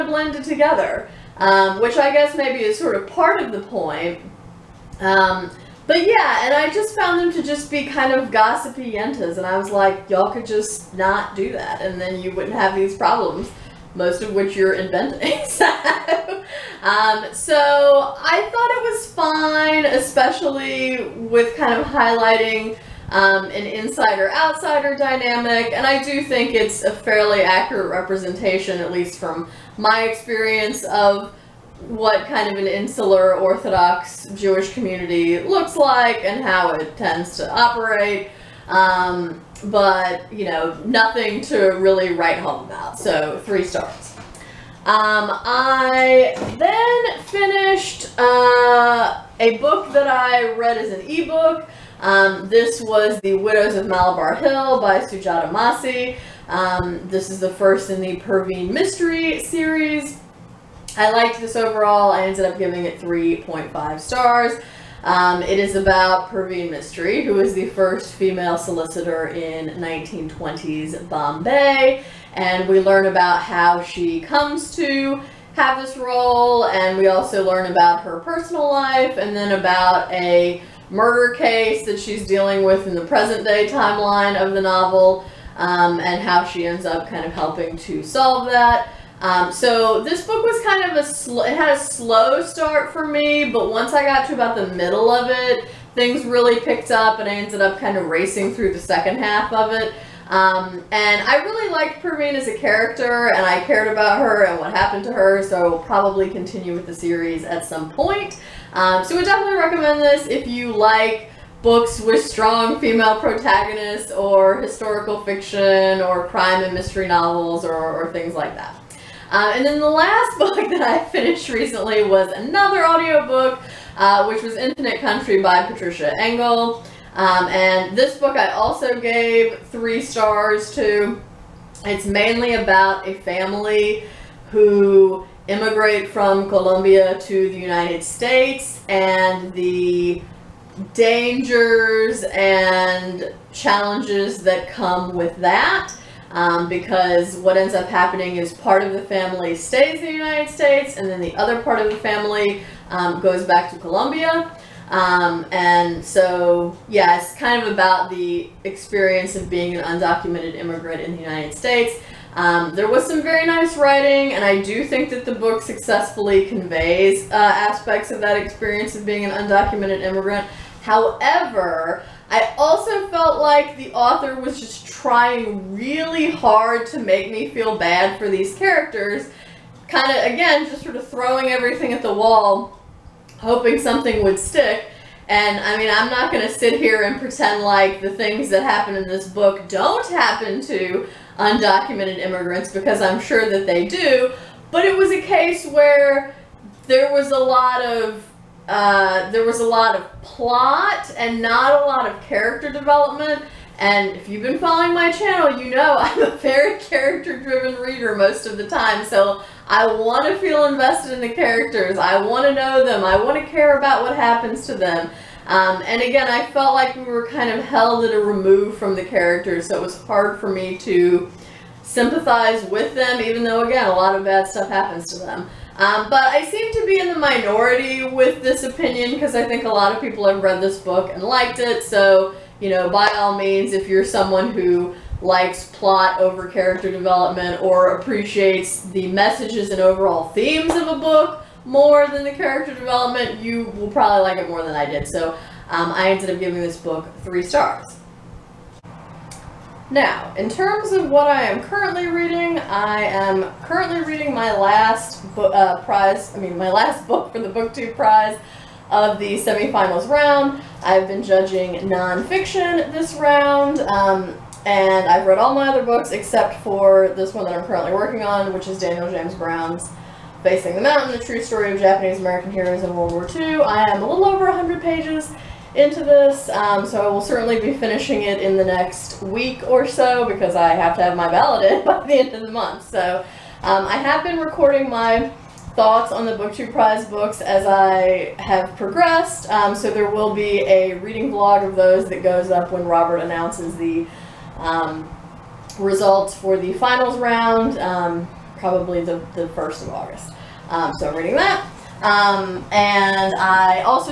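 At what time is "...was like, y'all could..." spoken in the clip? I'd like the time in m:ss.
0:09.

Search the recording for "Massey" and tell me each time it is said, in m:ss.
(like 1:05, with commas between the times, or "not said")
0:55.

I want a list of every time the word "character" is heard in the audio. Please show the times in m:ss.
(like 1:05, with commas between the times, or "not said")
1:42, 2:58, 3:22, 3:26, 3:31, 3:39, 3:56, 4:02.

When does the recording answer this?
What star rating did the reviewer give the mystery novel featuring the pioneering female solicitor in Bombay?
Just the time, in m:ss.
1:02.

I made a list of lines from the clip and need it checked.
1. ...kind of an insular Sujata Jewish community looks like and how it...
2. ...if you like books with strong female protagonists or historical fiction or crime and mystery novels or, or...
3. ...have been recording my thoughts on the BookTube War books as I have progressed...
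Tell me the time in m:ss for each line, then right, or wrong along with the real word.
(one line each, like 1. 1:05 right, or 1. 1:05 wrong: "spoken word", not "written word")
1. 0:32 wrong: "Orthodox", not "Sujata"
2. 1:50 right
3. 4:43 wrong: "Prize", not "War".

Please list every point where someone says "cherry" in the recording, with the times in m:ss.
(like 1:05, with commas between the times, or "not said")
not said.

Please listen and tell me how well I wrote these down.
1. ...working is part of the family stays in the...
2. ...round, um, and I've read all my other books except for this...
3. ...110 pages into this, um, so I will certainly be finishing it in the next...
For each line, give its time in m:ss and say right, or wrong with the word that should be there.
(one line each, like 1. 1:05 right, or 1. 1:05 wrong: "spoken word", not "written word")
1. 2:27 wrong: "happening", not "working"
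2. 4:23 right
3. 4:34 wrong: "100", not "110".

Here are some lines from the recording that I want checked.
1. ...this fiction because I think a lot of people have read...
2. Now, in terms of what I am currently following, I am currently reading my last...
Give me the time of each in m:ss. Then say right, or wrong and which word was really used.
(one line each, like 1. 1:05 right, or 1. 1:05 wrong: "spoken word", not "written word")
1. 3:48 wrong: "opinion", not "fiction"
2. 4:09 wrong: "reading", not "following".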